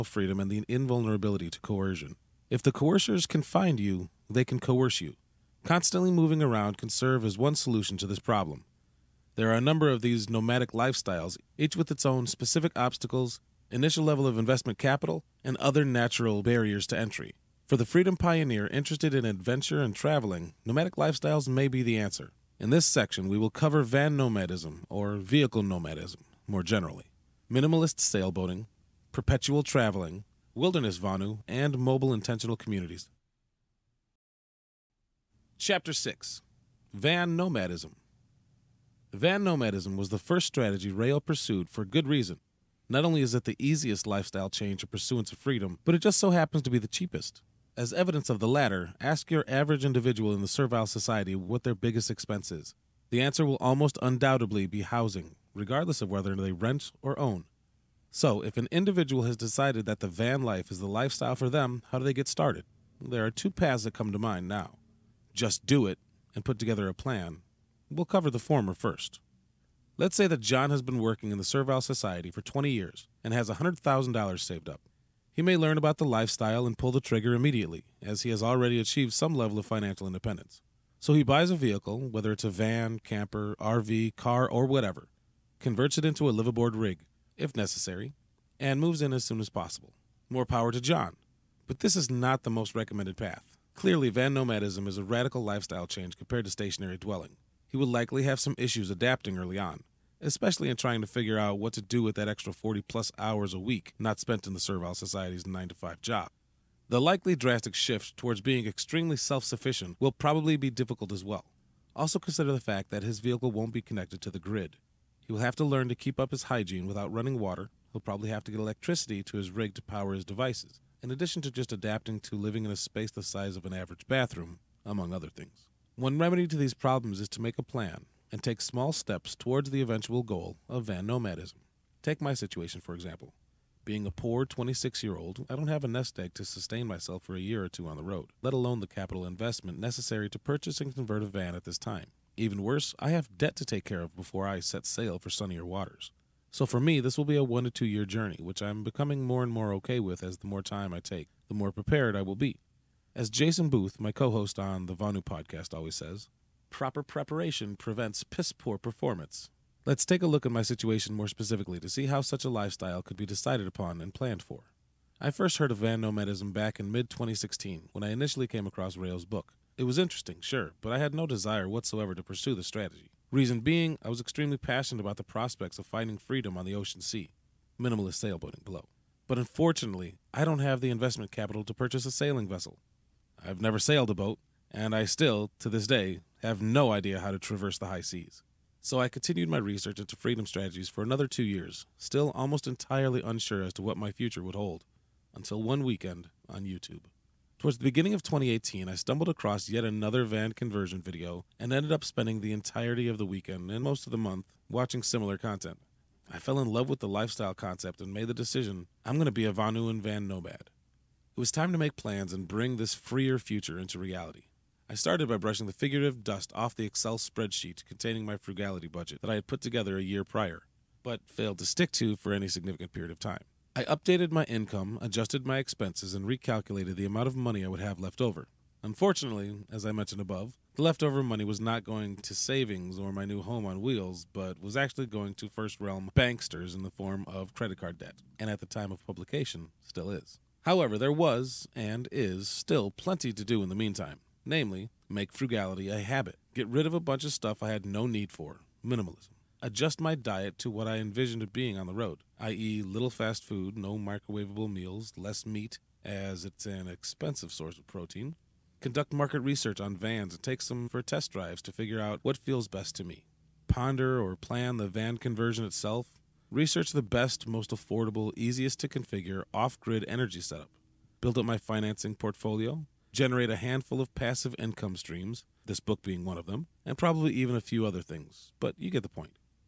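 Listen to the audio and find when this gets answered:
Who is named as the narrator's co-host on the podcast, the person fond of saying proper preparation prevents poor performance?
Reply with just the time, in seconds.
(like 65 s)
153 s.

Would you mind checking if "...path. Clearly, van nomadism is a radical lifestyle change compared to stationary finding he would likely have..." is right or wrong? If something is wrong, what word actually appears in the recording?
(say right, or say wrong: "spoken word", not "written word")
wrong: "dwelling", not "finding".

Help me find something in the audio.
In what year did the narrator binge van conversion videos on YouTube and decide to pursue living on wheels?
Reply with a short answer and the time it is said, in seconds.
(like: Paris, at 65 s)
2018, at 198 s.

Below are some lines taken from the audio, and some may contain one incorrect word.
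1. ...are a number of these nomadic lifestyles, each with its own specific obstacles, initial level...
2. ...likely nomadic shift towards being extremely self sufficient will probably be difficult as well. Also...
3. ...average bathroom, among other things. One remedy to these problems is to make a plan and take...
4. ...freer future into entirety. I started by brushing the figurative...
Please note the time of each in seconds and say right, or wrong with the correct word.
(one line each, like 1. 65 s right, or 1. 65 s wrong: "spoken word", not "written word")
1. 9 s right
2. 107 s wrong: "drastic", not "nomadic"
3. 123 s right
4. 212 s wrong: "reality", not "entirety".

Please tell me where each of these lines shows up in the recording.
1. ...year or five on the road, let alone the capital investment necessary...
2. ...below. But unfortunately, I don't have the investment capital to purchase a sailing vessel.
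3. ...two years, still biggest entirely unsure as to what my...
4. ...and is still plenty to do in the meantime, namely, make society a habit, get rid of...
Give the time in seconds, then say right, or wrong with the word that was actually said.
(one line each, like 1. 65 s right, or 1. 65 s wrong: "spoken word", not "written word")
1. 137 s wrong: "two", not "five"
2. 178 s right
3. 191 s wrong: "almost", not "biggest"
4. 241 s wrong: "frugality", not "society".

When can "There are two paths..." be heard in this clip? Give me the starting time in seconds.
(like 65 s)
63 s.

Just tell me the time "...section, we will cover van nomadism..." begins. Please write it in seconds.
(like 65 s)
22 s.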